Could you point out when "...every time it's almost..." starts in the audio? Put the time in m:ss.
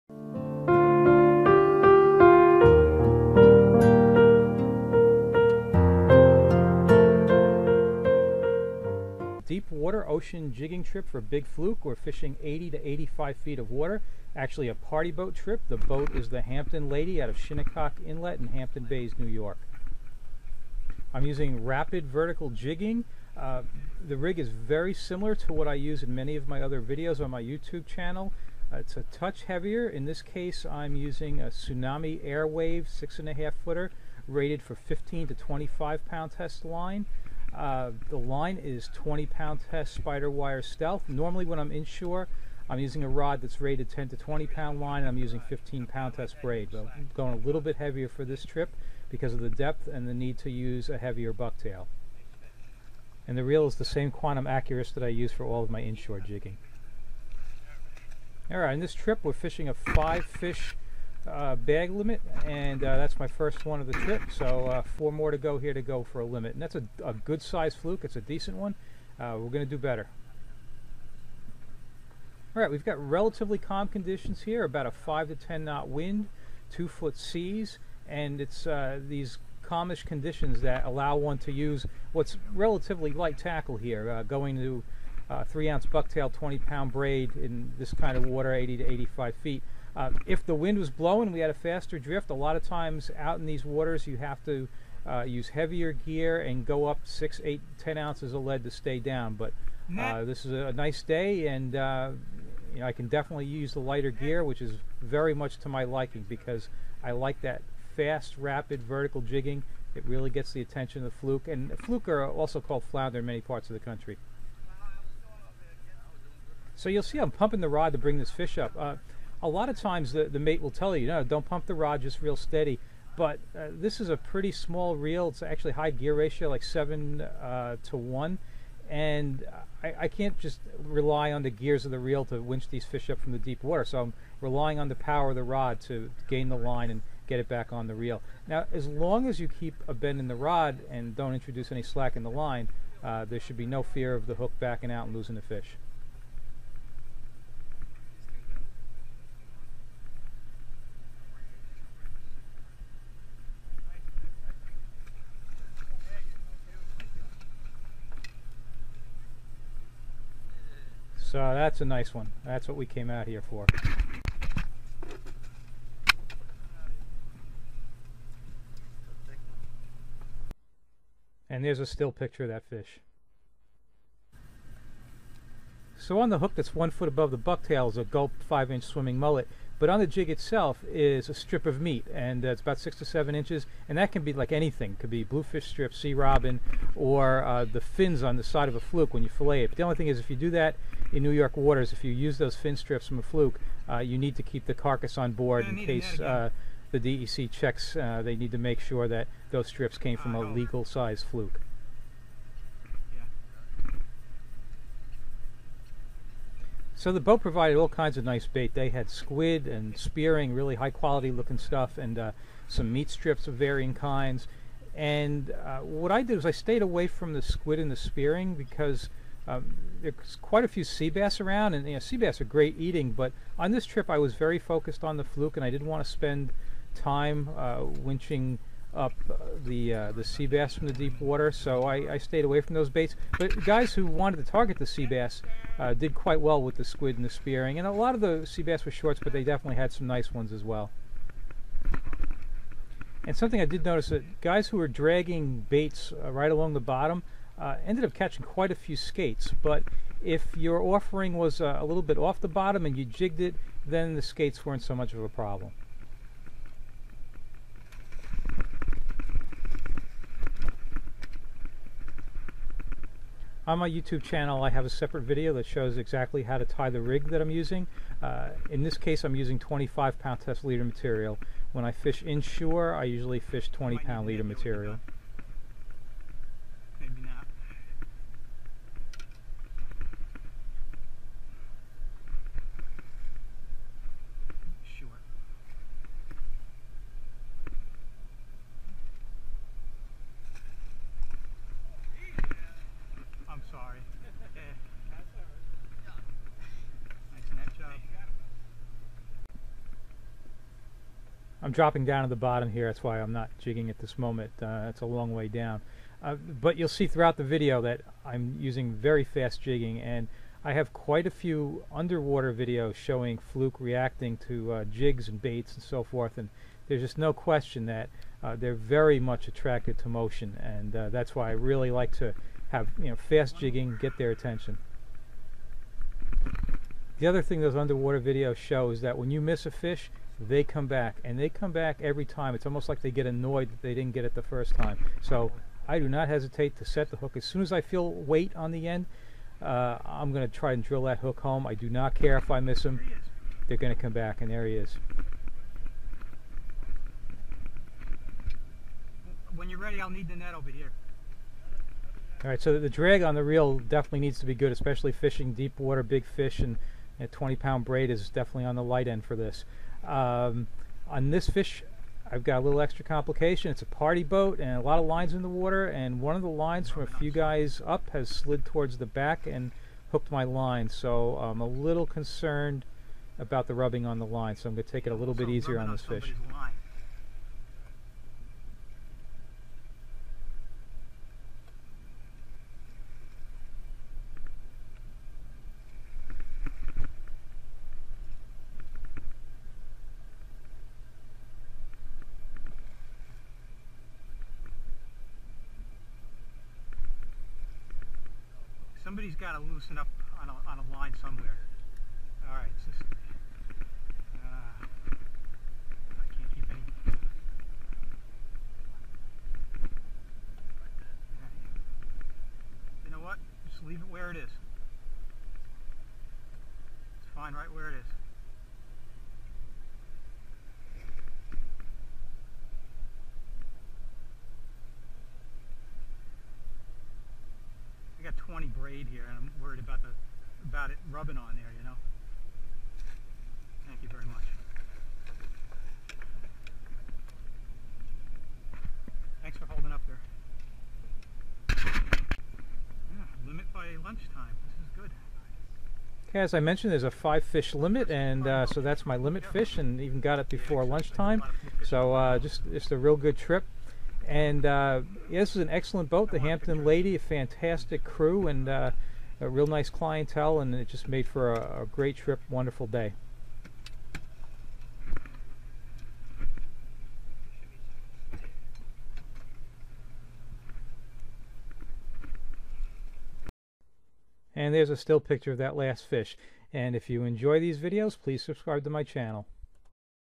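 5:32.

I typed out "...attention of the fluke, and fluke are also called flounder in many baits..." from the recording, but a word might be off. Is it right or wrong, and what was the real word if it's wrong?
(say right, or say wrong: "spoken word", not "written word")
wrong: "parts", not "baits".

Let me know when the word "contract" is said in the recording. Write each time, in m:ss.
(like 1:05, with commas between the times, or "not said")
not said.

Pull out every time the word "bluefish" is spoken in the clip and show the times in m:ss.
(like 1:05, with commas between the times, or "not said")
3:05.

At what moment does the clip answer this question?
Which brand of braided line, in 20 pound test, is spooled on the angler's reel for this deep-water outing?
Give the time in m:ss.
0:40.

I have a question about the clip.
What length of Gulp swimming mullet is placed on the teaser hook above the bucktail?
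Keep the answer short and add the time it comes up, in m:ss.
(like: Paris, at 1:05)
5 inch, at 2:58.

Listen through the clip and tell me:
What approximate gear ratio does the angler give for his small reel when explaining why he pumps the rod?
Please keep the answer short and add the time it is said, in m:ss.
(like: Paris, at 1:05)
7 to 1, at 2:06.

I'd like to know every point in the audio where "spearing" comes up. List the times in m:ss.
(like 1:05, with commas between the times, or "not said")
3:29, 3:37, 3:57.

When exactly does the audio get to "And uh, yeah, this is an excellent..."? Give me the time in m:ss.
7:34.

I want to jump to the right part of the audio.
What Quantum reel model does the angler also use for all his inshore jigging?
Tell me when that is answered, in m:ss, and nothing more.
0:54.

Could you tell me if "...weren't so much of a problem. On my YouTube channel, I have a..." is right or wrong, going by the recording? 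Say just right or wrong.
right.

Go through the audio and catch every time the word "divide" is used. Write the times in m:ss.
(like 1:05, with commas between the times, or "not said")
not said.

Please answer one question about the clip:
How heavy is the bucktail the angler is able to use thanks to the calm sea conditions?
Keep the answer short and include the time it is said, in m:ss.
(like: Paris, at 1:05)
3 ounce, at 1:25.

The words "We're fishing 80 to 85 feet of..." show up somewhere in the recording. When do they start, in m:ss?
0:11.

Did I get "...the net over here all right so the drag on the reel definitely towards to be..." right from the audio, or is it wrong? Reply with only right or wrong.
wrong.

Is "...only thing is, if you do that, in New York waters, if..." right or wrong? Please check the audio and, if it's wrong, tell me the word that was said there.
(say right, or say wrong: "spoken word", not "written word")
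right.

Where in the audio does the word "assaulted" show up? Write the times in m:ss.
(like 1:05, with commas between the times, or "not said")
not said.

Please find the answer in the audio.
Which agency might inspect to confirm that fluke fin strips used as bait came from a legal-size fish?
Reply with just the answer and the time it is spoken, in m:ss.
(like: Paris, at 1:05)
DEC, at 3:16.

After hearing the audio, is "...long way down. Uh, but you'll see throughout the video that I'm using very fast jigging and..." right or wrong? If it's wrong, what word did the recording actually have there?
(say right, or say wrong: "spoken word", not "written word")
right.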